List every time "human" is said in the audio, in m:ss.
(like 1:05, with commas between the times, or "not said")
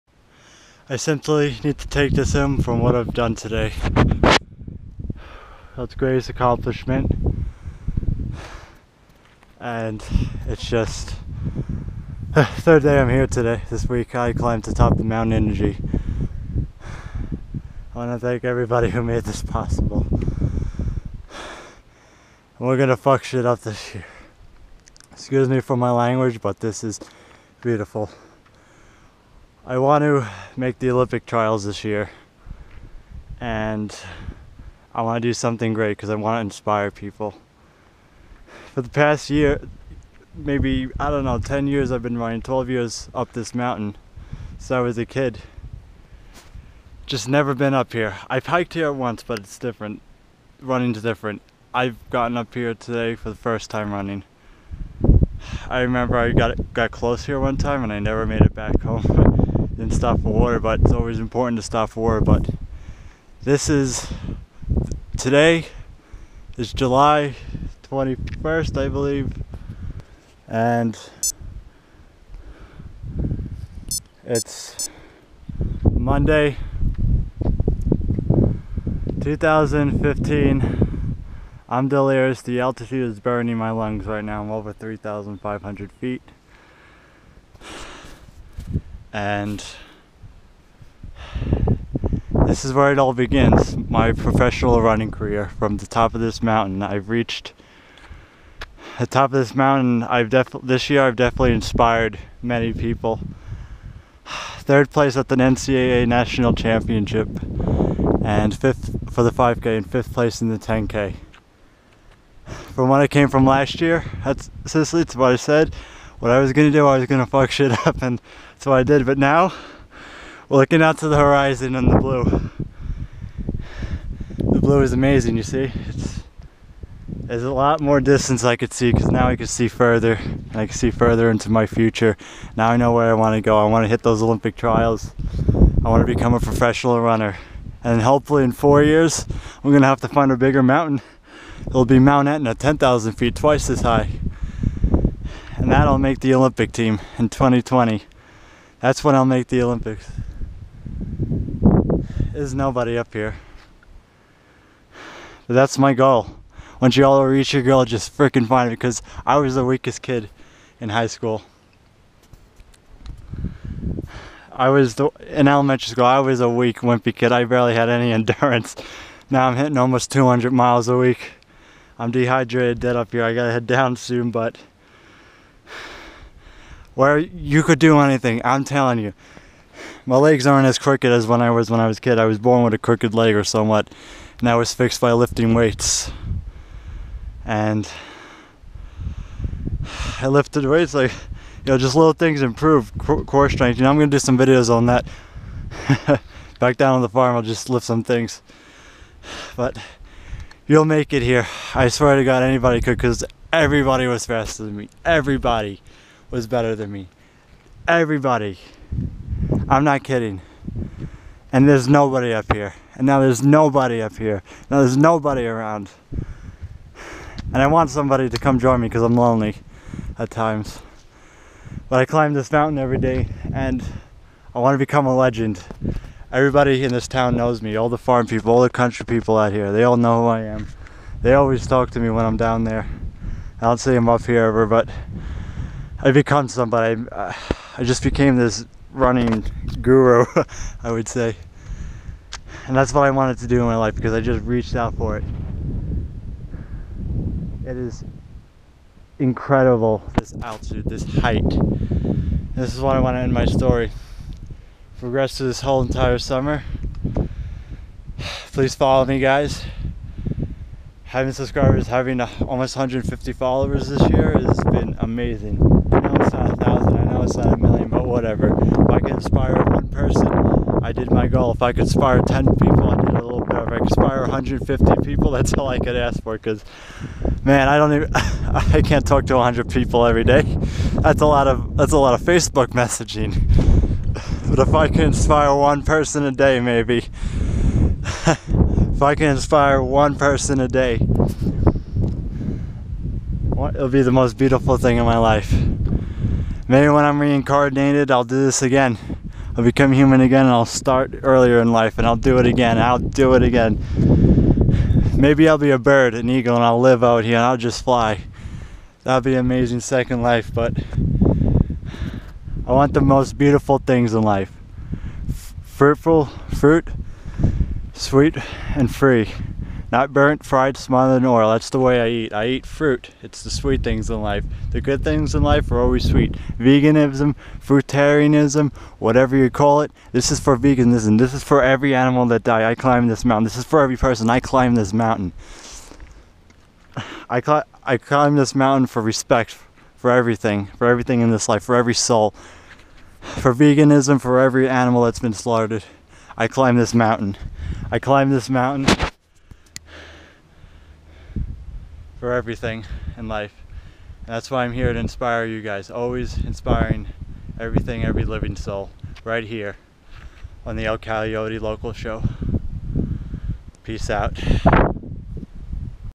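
4:59.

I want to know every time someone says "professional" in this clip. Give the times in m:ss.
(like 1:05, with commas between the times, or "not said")
1:34, 2:16.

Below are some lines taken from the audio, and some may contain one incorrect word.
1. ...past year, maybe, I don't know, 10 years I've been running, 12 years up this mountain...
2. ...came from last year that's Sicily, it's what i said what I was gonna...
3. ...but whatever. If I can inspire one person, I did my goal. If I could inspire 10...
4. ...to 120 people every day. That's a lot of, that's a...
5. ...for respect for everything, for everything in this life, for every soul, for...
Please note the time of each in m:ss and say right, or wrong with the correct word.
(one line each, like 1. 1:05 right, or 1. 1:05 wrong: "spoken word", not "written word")
1. 0:38 right
2. 1:53 right
3. 4:27 right
4. 4:39 wrong: "100", not "120"
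5. 5:38 right.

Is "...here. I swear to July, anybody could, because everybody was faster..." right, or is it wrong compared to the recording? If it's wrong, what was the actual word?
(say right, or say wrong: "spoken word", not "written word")
wrong: "God", not "July".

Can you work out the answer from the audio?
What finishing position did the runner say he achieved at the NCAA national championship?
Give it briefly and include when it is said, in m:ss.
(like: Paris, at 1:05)
third place, at 1:44.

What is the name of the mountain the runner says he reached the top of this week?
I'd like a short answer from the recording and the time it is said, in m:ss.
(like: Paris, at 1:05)
Mount Inici, at 0:15.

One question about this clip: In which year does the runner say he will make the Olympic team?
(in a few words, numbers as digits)
2020.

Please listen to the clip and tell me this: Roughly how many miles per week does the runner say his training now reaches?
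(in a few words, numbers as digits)
almost 200 miles.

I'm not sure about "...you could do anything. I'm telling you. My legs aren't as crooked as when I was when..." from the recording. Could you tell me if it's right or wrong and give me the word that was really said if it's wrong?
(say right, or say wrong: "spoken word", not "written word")
right.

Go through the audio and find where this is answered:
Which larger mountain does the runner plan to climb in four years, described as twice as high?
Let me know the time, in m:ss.
2:21.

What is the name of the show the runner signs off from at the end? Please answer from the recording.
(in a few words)
El Coyote Loco Show.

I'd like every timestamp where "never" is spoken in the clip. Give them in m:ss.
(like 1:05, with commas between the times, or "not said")
0:47, 0:57.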